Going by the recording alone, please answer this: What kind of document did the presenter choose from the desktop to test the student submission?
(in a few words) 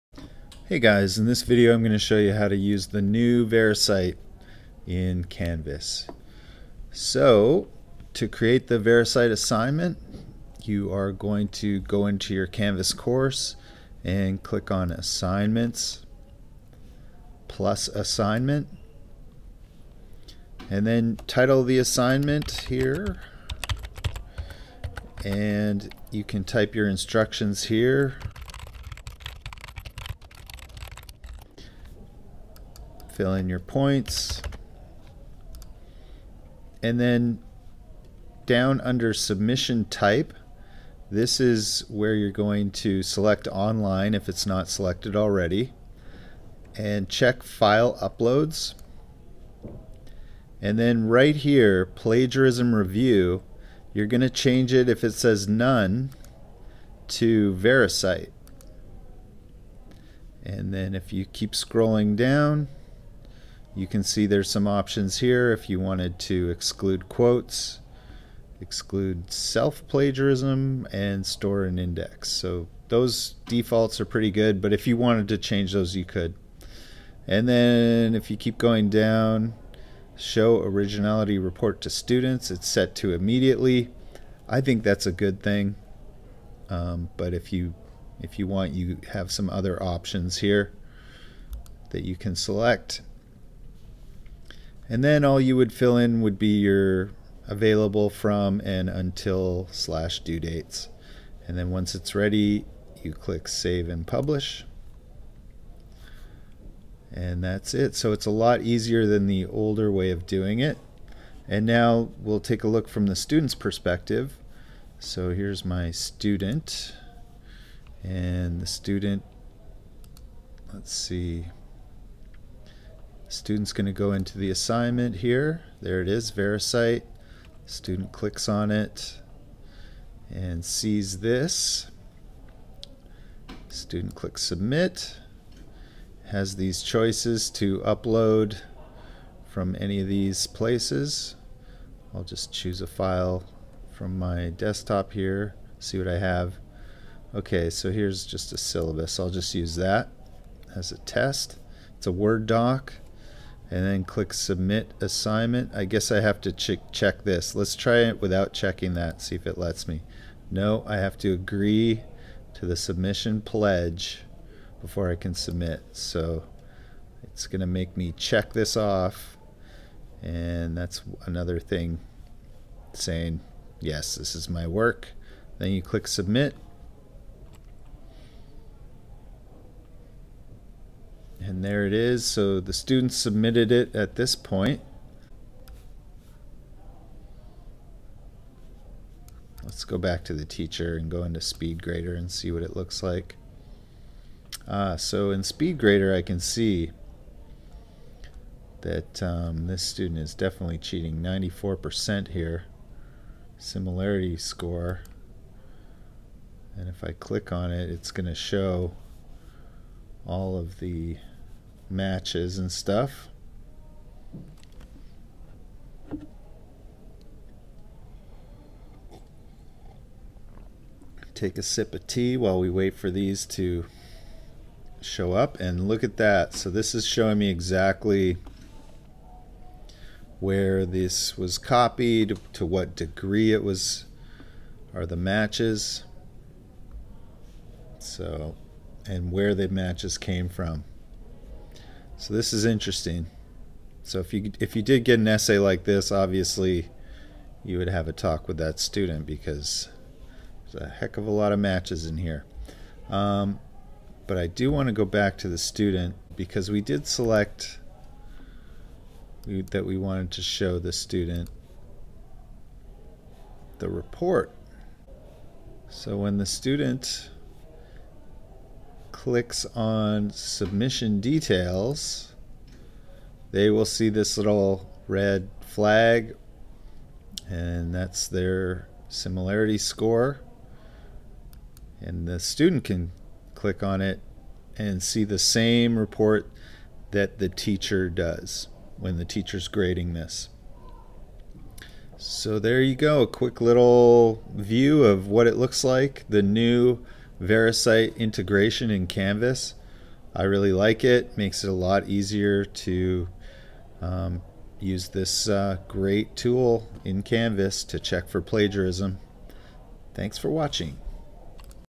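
A syllabus.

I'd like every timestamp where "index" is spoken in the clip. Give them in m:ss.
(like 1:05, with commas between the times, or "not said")
1:11.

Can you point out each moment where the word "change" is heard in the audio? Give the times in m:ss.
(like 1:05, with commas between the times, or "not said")
0:54, 1:15.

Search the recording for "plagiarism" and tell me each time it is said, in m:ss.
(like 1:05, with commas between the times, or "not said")
0:51, 1:09, 5:08.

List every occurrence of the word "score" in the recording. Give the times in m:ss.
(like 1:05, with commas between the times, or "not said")
3:24, 4:39.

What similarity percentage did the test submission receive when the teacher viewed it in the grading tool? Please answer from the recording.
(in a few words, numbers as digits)
94%.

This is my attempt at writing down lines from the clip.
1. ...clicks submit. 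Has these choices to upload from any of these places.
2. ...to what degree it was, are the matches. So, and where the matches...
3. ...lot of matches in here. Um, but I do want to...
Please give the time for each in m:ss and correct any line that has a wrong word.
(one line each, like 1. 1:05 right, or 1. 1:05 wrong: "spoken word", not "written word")
1. 2:14 right
2. 3:52 right
3. 4:11 right.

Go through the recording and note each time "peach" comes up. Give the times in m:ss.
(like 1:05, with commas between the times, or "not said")
not said.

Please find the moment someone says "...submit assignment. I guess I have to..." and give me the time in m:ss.
2:34.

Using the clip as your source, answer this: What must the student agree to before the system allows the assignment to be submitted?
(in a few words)
The submission pledge.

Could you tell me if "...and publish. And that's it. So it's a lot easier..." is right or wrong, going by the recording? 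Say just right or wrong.
right.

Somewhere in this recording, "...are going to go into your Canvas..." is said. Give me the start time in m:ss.
0:10.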